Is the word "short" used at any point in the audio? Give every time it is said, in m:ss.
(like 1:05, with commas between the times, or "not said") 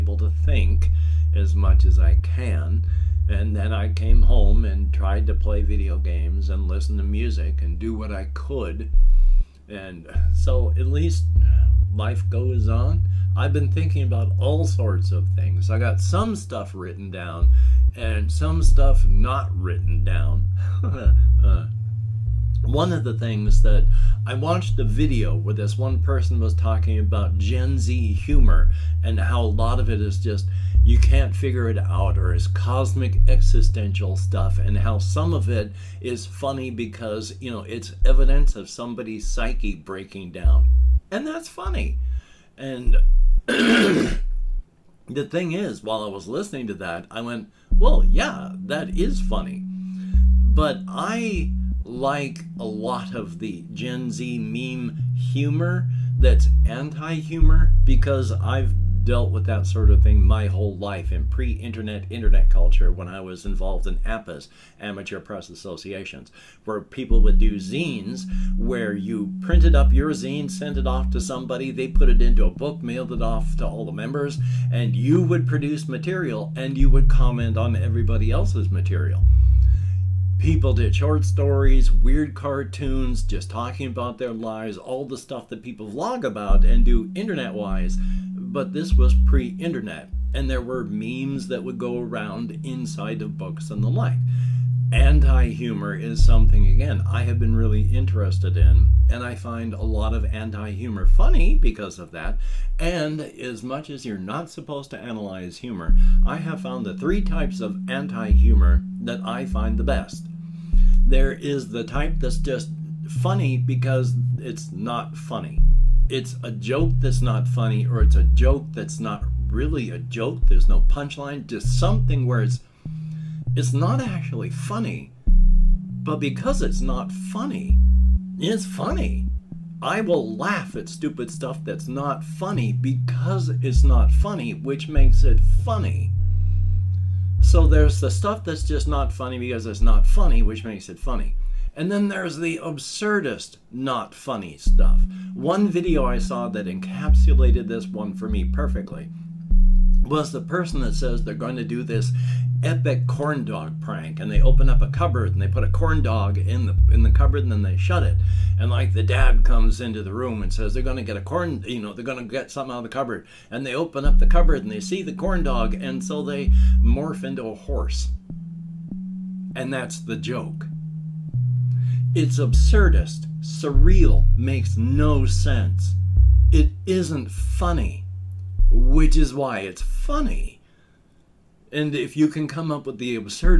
1:20.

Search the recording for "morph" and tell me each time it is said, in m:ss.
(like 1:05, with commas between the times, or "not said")
2:46.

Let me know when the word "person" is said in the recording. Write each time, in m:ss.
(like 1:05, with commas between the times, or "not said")
0:26, 2:30.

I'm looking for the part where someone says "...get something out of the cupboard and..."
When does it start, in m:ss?
2:42.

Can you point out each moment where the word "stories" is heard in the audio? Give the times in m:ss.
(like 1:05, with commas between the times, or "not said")
1:21.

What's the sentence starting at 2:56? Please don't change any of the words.
It isn't funny, which is why it's funny.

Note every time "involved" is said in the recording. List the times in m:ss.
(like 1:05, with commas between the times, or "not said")
1:03.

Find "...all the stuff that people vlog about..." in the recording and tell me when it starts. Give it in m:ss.
1:24.